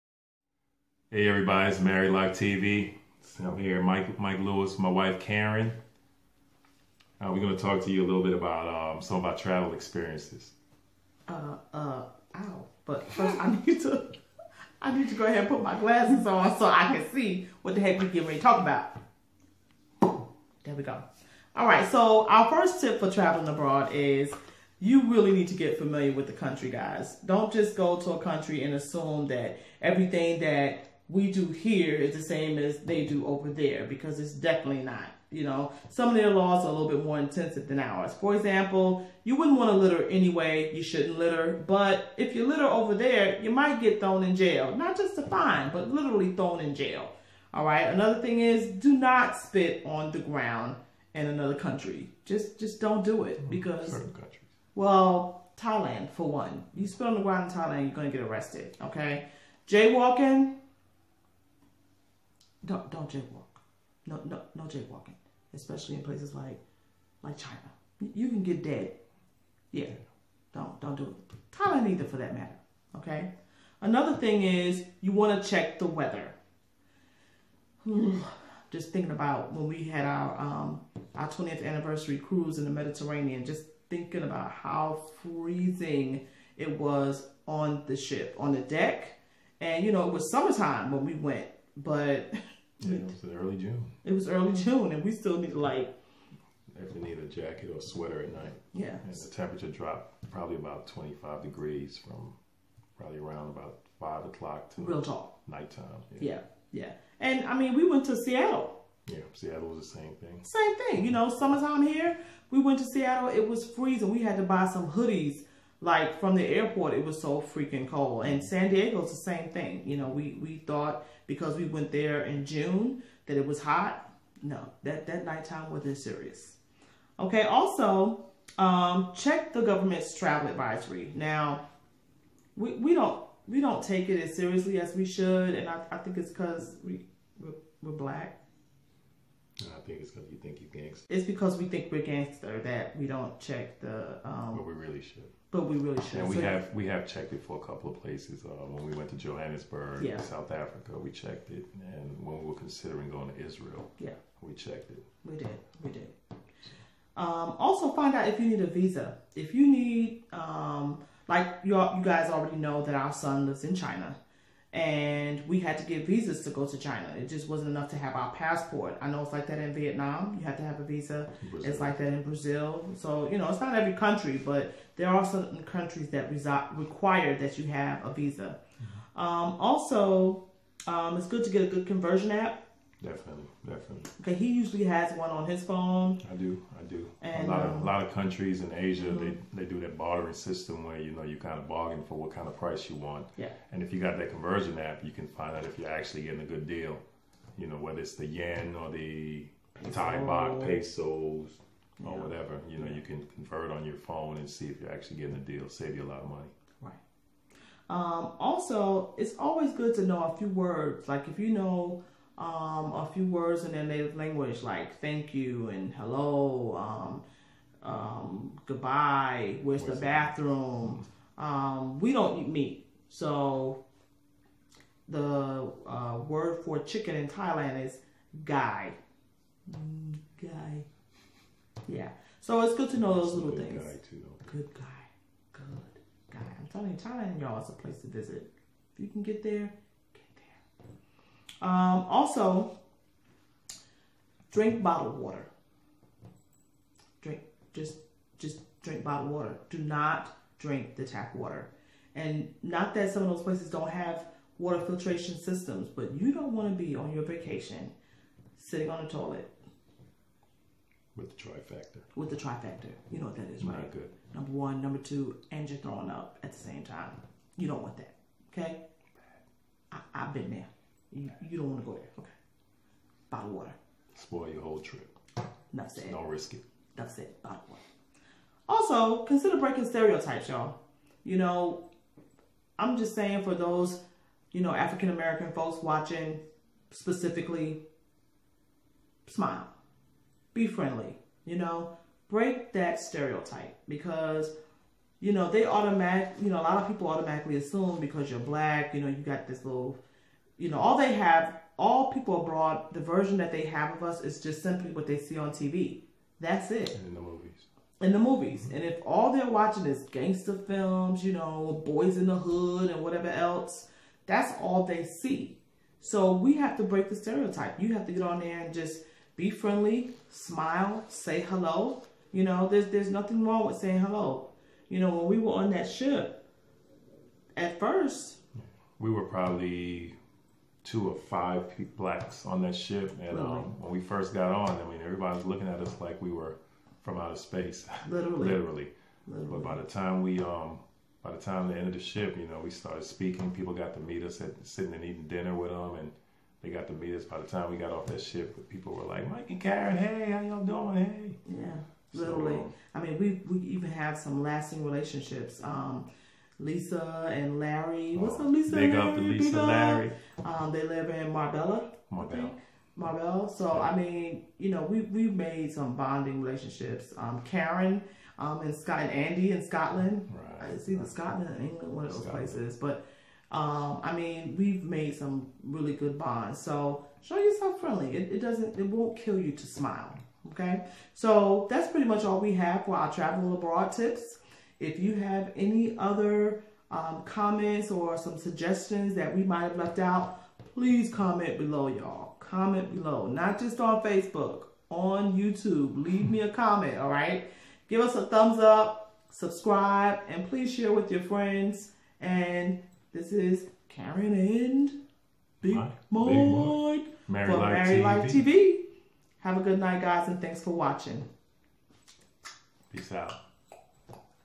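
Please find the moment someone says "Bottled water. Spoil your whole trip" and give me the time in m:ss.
4:33.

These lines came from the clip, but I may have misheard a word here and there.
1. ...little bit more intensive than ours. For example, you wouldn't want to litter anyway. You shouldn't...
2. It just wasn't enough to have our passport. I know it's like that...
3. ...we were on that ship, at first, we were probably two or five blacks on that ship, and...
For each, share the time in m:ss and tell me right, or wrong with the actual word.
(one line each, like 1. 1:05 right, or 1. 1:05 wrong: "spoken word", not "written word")
1. 0:36 right
2. 2:47 right
3. 5:25 right.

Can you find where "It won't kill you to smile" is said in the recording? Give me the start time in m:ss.
6:18.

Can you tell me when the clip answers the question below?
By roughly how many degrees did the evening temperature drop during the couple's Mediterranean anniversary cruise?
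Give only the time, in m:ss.
1:40.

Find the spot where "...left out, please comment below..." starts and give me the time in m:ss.
6:29.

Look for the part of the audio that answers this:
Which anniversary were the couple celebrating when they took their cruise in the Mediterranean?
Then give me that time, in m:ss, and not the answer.
1:21.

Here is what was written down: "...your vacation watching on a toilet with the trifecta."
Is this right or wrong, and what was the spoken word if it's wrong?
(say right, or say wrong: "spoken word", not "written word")
wrong: "sitting", not "watching".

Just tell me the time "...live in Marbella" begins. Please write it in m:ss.
6:00.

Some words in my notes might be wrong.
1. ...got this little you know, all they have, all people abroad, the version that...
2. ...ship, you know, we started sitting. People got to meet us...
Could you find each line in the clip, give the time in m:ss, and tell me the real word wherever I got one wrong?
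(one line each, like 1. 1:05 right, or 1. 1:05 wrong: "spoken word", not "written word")
1. 4:59 right
2. 5:41 wrong: "speaking", not "sitting".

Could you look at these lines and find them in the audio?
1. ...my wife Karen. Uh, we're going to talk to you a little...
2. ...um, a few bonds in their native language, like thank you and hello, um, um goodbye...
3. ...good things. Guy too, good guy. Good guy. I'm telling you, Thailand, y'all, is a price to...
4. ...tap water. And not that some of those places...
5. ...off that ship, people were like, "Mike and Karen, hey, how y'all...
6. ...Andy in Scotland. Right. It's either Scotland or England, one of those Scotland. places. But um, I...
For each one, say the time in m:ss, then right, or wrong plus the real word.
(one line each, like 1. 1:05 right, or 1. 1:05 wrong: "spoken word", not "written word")
1. 0:04 right
2. 3:32 wrong: "words", not "bonds"
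3. 3:53 wrong: "place", not "price"
4. 4:11 right
5. 5:47 right
6. 6:09 right.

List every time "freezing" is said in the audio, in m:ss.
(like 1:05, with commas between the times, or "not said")
1:25, 1:53.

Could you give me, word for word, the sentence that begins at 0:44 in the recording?
Not just a fine, but literally thrown in jail.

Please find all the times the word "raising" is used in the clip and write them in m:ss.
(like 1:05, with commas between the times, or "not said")
not said.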